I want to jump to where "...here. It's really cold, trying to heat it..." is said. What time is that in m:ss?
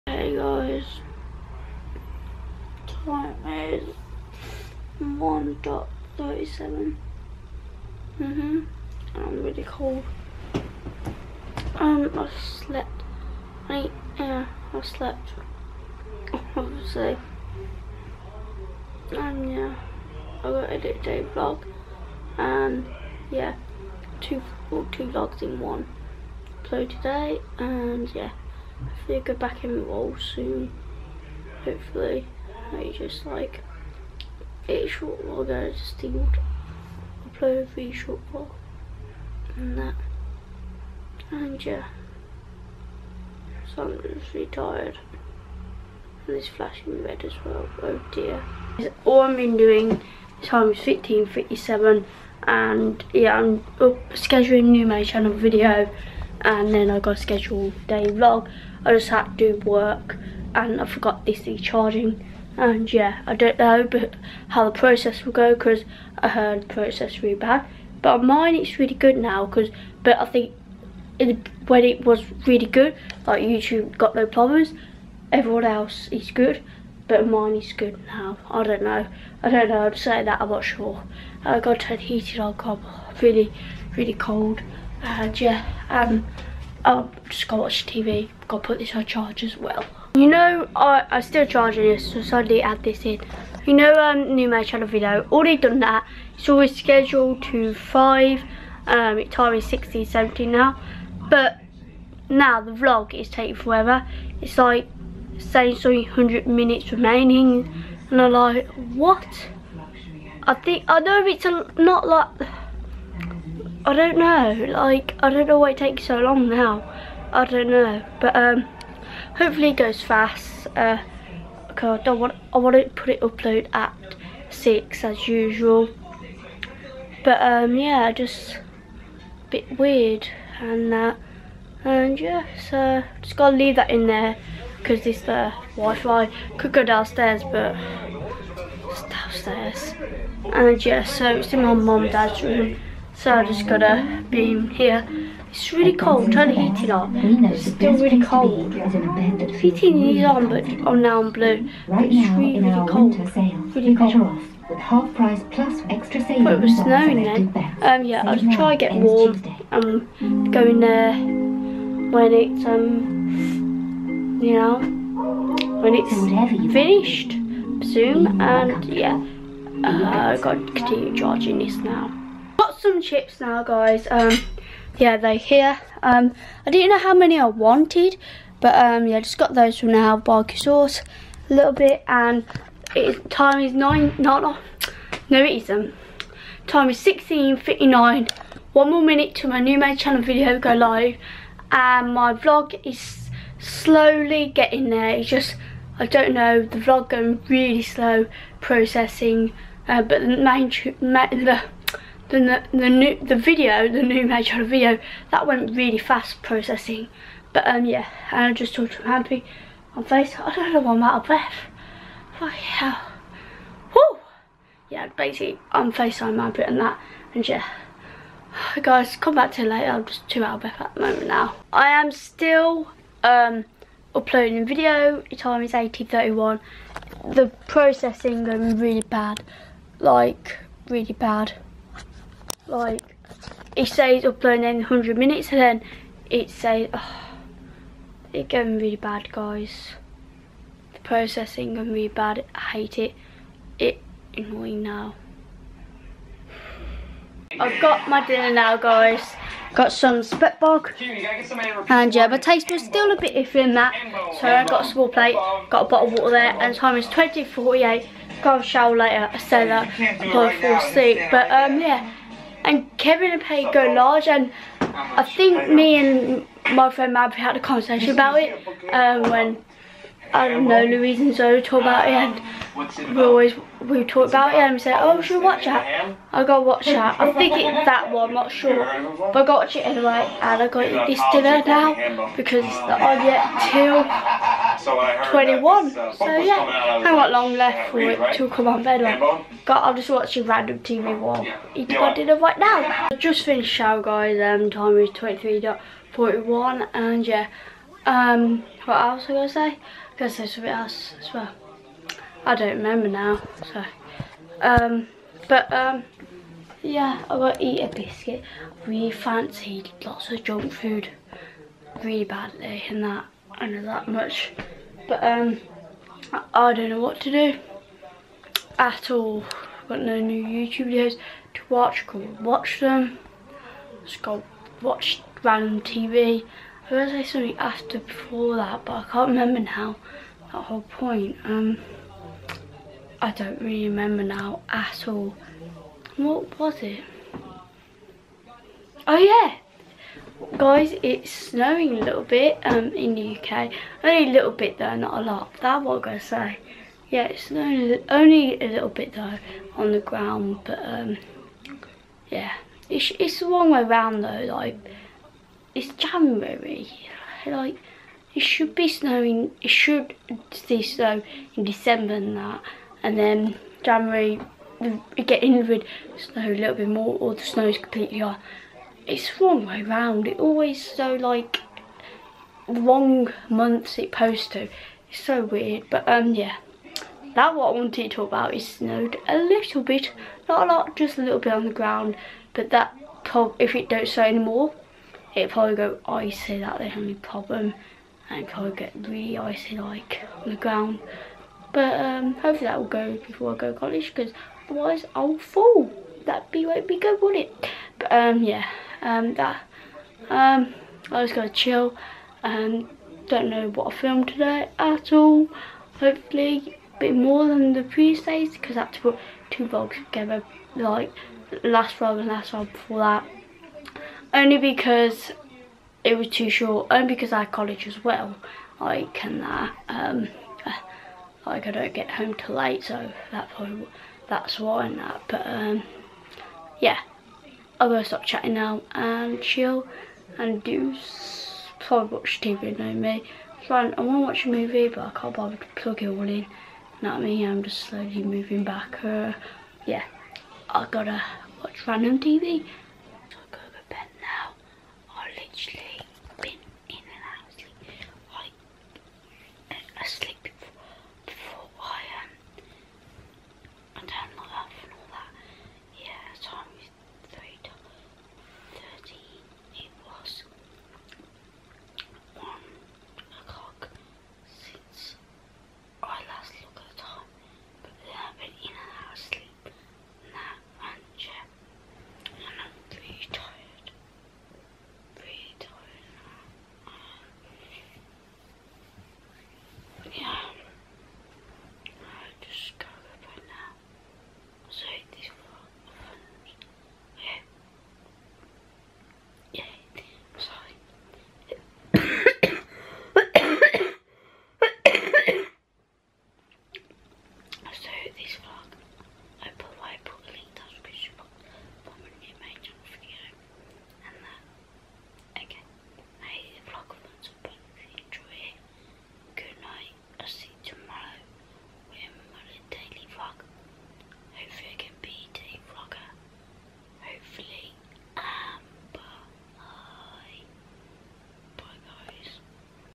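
2:24.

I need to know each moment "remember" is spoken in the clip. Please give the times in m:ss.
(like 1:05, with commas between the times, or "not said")
5:02, 5:29, 5:33.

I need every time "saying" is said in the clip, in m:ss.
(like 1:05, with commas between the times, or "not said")
1:19, 1:45.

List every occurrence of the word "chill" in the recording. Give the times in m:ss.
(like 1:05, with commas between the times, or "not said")
6:41, 7:09.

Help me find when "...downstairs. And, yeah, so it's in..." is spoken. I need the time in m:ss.
2:19.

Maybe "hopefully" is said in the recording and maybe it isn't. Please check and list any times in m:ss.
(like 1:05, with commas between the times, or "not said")
0:31, 1:59, 6:32, 6:45.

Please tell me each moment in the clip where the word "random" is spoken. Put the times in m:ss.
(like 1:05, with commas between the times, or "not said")
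4:50, 5:25, 7:21.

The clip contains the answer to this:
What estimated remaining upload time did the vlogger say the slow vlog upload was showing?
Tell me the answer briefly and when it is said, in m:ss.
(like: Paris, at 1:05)
300 minutes, at 1:45.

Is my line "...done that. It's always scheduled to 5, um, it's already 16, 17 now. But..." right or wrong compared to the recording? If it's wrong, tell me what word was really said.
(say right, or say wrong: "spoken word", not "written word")
right.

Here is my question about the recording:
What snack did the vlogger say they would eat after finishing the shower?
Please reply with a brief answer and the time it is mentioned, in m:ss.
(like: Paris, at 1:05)
a biscuit, at 5:07.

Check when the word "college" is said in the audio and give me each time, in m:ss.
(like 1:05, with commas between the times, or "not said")
6:33, 6:57.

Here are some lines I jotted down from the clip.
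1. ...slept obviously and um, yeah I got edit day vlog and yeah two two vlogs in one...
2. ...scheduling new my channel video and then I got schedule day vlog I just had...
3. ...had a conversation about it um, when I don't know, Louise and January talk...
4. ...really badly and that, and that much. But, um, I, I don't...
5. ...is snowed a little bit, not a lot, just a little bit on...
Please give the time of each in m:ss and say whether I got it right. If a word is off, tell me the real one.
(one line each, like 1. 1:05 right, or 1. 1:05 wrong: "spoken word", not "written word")
1. 0:14 right
2. 0:54 right
3. 4:27 wrong: "Zoe", not "January"
4. 5:12 right
5. 6:18 right.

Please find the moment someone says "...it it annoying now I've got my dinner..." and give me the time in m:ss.
4:02.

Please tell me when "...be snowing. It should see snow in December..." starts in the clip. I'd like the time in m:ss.
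5:58.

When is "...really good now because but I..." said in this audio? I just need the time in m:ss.
1:08.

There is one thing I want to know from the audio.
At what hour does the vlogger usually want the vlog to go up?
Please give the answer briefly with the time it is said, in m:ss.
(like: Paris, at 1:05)
6, at 2:04.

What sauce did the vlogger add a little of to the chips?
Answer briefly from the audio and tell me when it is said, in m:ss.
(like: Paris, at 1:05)
Barbecue sauce, at 3:00.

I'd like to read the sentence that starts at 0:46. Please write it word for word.
And it's flashing red as well.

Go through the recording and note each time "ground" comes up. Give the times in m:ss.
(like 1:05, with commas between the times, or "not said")
5:49, 6:21, 6:30.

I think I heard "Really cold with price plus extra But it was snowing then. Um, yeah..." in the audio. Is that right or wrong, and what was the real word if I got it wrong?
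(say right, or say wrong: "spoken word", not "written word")
right.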